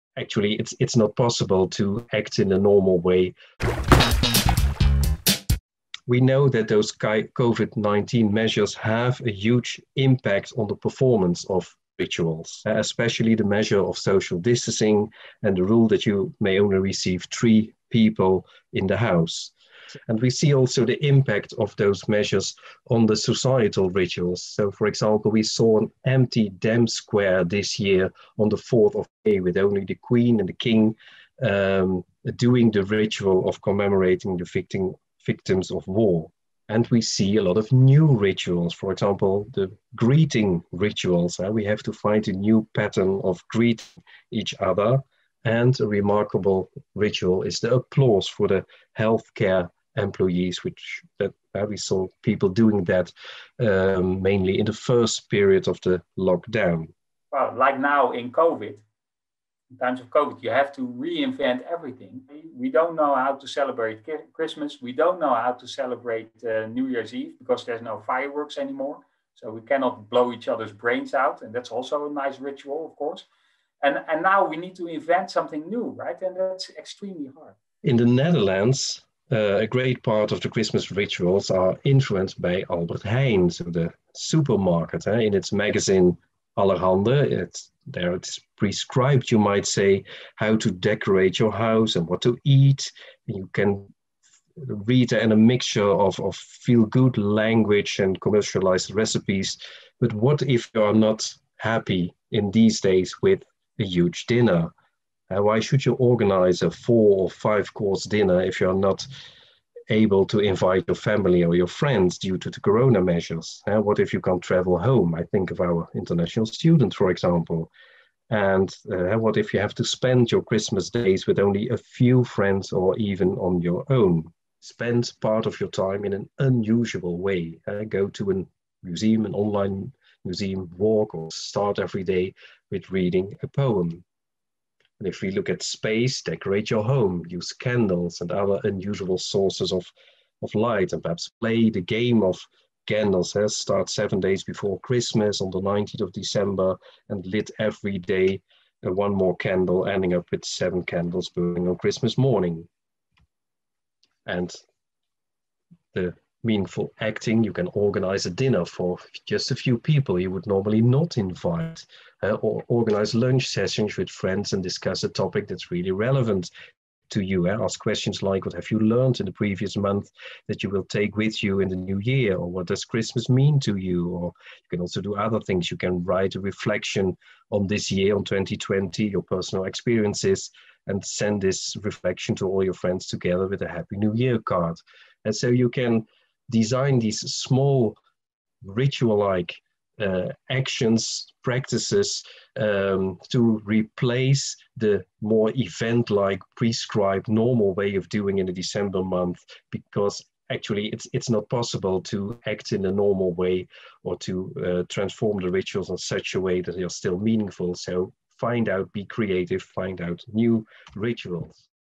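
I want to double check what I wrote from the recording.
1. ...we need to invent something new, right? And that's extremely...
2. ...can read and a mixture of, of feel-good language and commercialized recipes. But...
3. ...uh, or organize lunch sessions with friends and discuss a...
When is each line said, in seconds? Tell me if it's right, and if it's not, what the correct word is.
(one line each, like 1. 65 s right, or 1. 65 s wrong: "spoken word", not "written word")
1. 74 s right
2. 93 s right
3. 162 s right.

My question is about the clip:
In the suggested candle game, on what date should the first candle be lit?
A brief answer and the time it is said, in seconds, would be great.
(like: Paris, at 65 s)
19 December, at 145 s.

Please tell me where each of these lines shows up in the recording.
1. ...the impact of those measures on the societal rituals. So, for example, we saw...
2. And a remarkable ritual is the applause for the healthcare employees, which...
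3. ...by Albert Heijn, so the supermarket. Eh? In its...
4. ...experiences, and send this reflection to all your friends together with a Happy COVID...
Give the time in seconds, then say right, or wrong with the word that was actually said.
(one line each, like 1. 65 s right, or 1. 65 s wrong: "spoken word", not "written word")
1. 20 s right
2. 45 s right
3. 82 s right
4. 179 s wrong: "New", not "COVID".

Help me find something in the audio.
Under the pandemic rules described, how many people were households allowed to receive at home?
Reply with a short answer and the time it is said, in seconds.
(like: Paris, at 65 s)
3, at 17 s.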